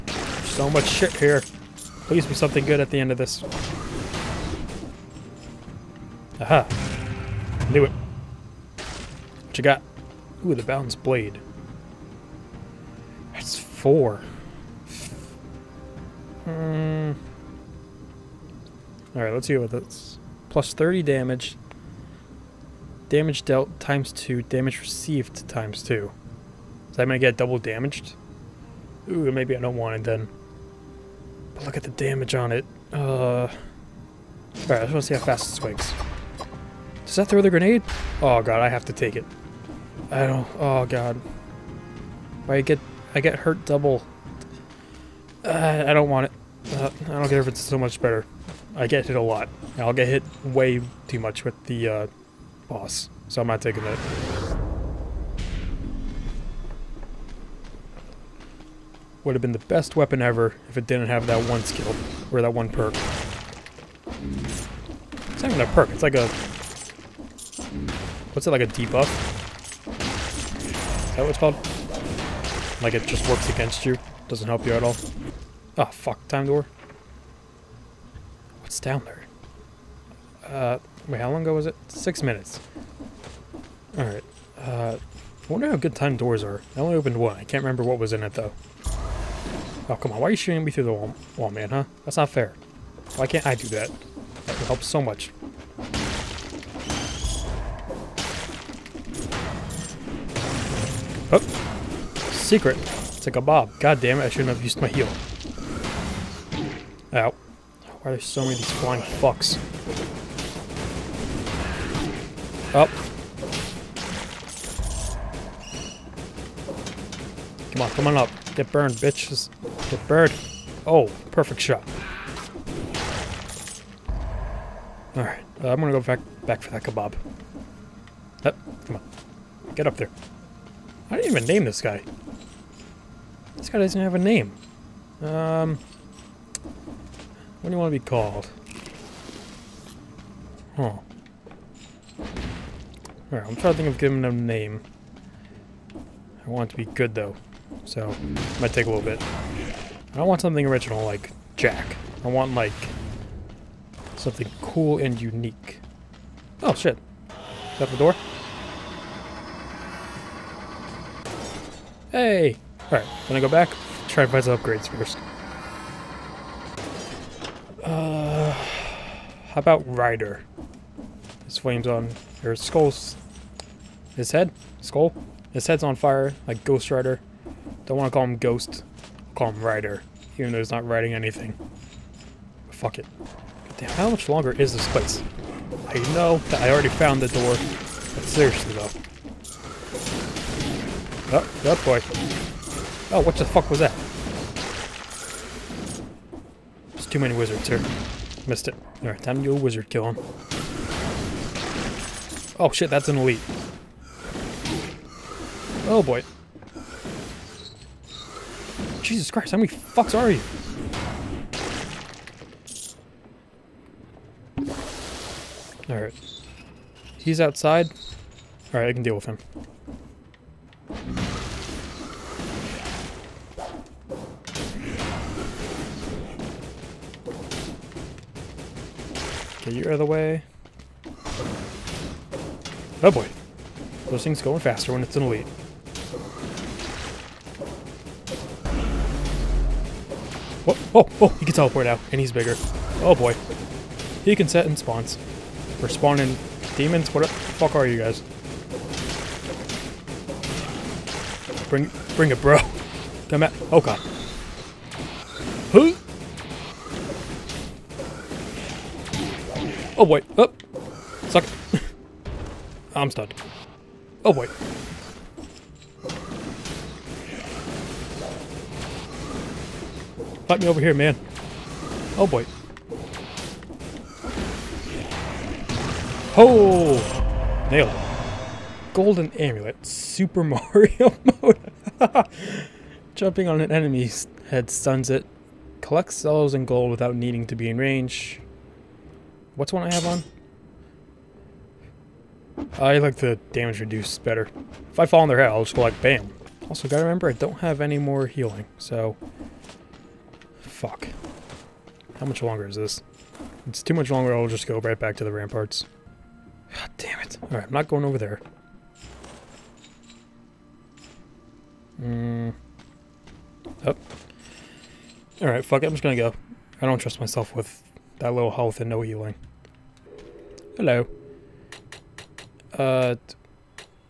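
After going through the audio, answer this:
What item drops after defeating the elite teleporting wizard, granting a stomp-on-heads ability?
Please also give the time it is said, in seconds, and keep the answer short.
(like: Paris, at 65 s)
Golden Amulet, at 278 s.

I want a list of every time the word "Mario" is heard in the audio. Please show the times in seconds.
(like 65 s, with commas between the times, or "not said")
280 s.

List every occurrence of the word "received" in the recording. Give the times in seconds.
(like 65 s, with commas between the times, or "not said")
24 s.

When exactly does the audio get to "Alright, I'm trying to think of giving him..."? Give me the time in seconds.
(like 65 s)
143 s.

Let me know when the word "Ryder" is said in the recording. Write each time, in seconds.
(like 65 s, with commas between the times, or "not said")
169 s, 179 s.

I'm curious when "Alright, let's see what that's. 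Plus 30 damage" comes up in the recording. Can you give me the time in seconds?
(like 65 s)
19 s.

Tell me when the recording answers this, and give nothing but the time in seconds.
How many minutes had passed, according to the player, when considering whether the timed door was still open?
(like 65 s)
81 s.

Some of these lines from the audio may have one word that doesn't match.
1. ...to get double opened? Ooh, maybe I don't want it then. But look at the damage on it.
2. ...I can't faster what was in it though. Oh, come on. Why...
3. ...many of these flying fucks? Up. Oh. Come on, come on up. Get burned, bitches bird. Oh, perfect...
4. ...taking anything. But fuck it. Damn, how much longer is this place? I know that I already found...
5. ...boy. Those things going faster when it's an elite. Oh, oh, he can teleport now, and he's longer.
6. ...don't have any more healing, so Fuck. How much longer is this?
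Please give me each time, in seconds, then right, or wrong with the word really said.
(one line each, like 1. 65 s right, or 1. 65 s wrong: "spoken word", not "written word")
1. 27 s wrong: "damaged", not "opened"
2. 87 s wrong: "remember", not "faster"
3. 108 s right
4. 180 s wrong: "riding", not "taking"
5. 233 s wrong: "bigger", not "longer"
6. 297 s right.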